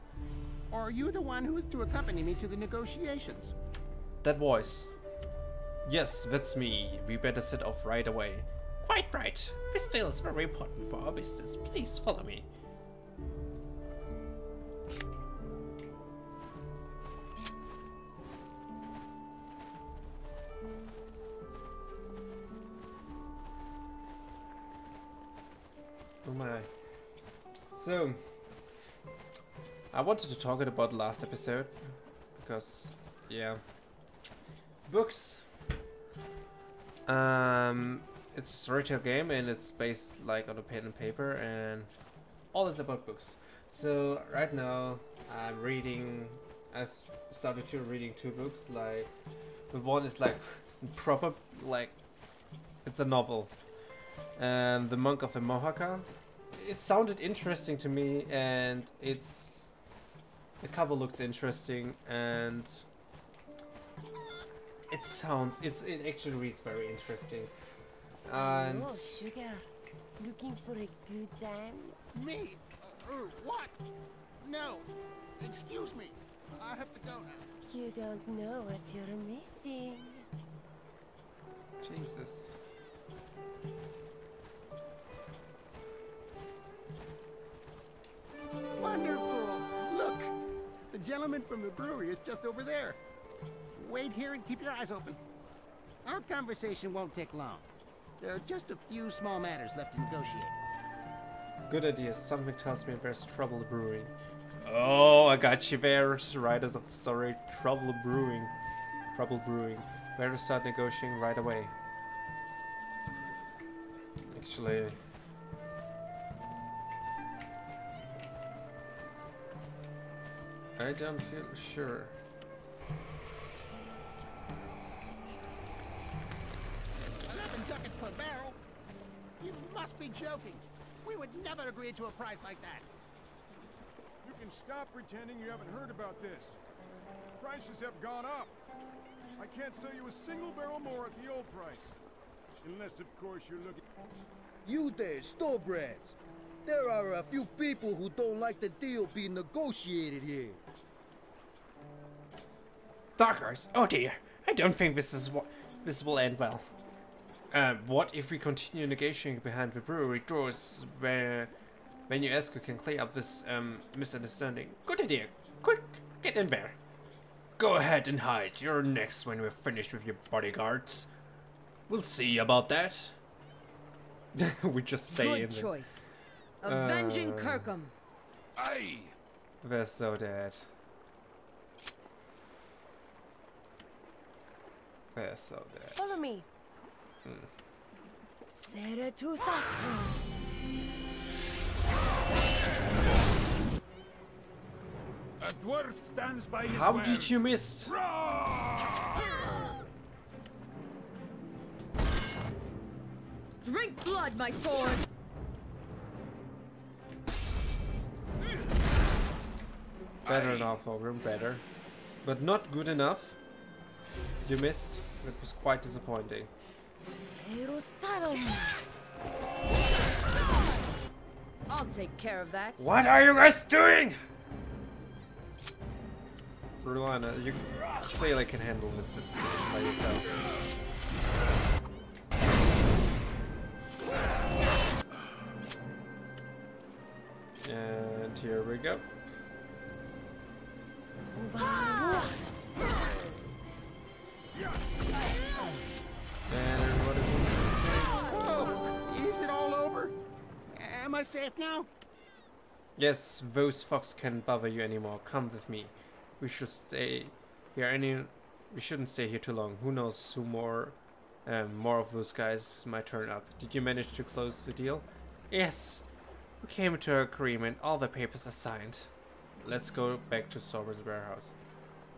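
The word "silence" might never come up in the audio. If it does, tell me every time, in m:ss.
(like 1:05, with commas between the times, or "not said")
not said.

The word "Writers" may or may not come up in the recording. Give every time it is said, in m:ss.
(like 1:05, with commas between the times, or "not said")
1:46.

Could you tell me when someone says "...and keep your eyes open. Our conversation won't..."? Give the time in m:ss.
1:34.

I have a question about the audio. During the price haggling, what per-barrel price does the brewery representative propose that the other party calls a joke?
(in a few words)
11 ducats.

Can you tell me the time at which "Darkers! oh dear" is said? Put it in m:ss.
2:33.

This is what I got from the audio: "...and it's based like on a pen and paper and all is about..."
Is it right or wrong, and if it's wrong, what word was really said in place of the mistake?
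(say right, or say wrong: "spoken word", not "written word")
right.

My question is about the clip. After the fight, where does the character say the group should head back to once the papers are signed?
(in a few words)
Sovereign's warehouse.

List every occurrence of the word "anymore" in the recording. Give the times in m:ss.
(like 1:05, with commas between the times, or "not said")
4:14.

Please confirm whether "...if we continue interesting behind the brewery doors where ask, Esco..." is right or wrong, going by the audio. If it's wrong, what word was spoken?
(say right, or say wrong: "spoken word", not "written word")
wrong: "negotiating", not "interesting".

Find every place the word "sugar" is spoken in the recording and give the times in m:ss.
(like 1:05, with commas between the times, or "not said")
1:08.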